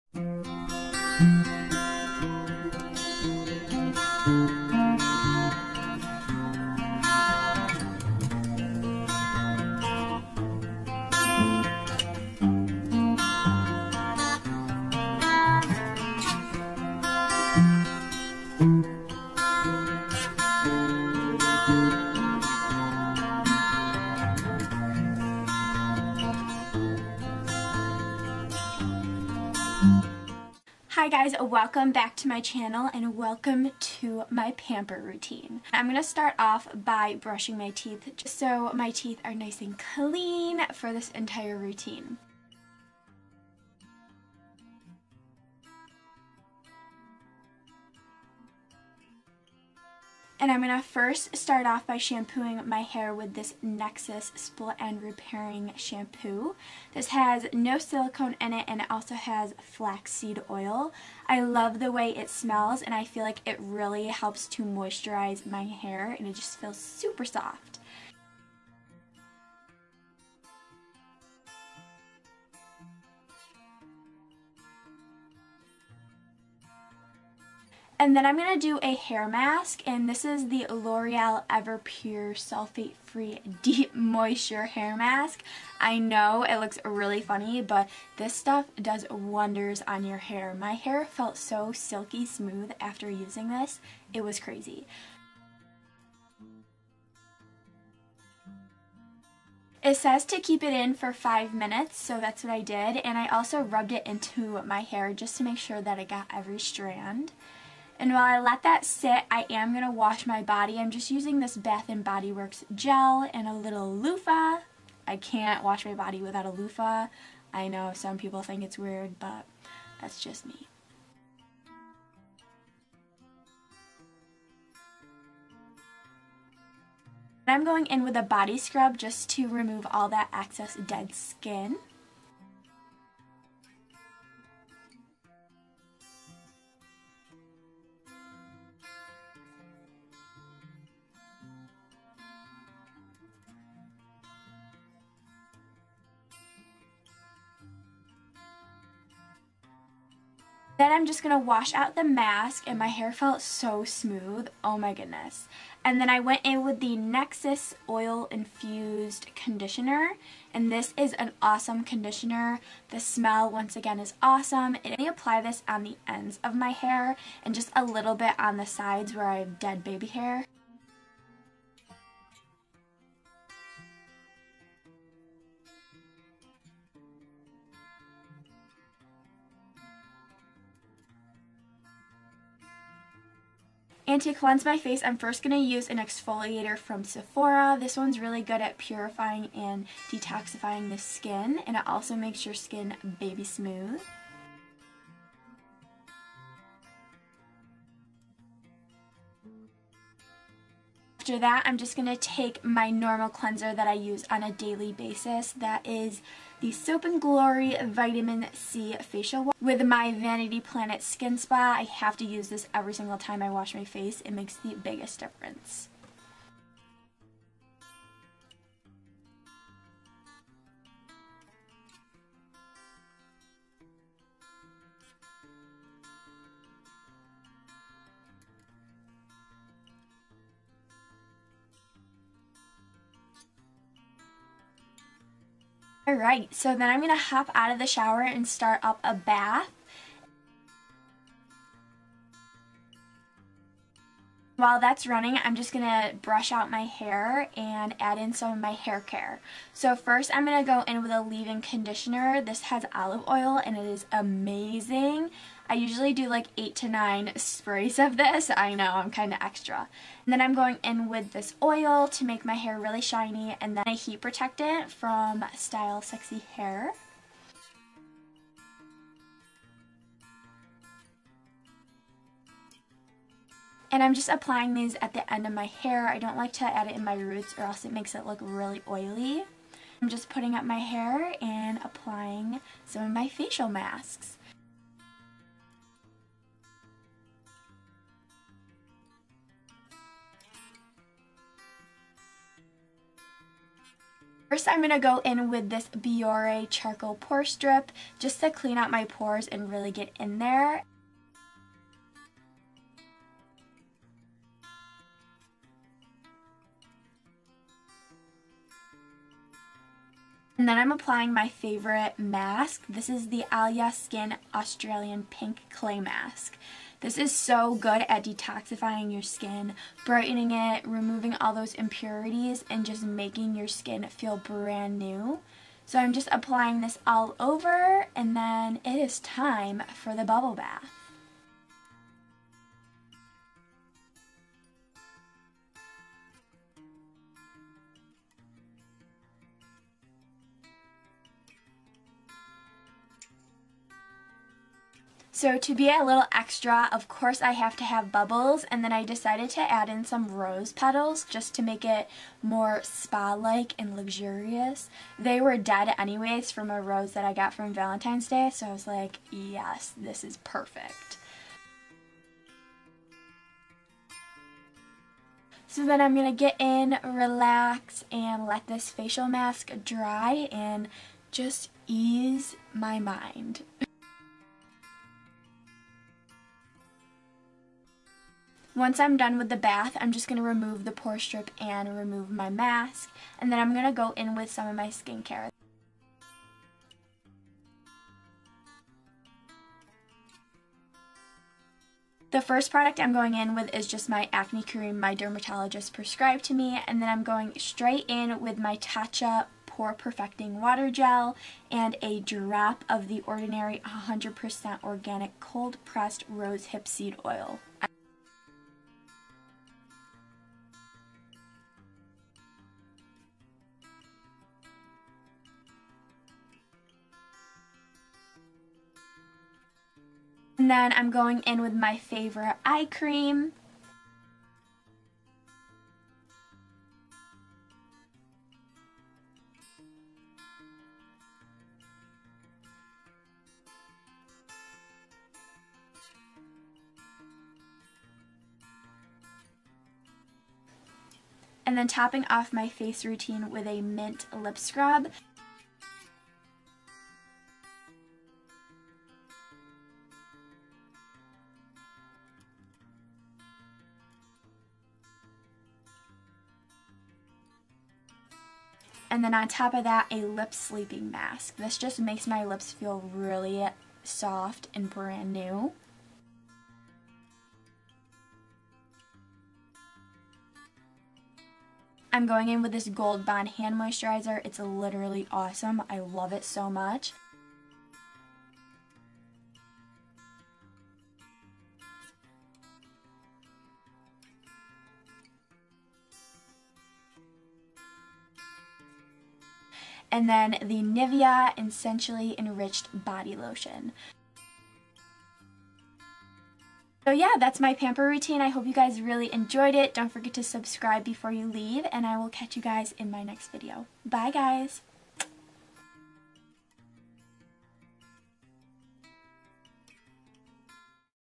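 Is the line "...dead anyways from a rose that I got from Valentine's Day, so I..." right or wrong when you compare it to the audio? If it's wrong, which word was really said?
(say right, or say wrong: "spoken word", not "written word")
right.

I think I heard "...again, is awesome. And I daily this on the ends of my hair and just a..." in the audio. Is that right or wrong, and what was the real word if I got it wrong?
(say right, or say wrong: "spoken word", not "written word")
wrong: "apply", not "daily".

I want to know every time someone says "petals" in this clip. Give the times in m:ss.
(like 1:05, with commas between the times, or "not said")
5:50.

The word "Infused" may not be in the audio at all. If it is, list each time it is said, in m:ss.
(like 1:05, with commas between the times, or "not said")
2:38.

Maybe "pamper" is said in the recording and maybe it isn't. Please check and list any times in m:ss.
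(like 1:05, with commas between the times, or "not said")
0:34, 8:17.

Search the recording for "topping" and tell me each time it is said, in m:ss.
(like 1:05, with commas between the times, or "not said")
7:21.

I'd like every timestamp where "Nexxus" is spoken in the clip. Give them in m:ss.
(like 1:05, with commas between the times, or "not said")
0:53, 2:36.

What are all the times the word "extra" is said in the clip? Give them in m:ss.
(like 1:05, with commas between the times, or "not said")
4:19, 5:46.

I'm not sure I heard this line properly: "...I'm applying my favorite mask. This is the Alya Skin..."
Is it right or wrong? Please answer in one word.
right.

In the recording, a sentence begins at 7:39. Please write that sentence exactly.
and then on top of that, a lip sleeping mask.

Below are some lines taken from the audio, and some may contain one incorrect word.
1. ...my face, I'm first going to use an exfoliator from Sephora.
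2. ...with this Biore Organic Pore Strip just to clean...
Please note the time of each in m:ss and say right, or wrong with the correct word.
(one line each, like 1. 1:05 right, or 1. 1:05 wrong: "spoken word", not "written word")
1. 3:04 right
2. 4:55 wrong: "Charcoal", not "Organic".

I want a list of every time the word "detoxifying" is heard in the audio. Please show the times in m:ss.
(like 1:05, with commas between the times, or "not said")
3:10, 5:18.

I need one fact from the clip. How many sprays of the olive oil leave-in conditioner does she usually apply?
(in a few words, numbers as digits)
8 to 9.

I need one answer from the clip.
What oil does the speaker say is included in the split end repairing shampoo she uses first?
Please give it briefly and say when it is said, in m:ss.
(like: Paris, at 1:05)
Flaxseed oil, at 0:59.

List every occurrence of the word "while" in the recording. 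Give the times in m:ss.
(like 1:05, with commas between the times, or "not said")
1:48, 4:04.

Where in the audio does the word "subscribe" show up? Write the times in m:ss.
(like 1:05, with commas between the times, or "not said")
8:20.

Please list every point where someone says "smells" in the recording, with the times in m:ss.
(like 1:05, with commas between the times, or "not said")
1:02, 2:42.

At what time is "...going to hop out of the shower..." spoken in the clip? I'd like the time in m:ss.
3:56.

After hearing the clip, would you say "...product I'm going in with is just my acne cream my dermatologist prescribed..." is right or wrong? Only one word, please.
right.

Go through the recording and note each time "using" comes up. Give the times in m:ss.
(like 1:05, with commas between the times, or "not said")
1:33, 1:51.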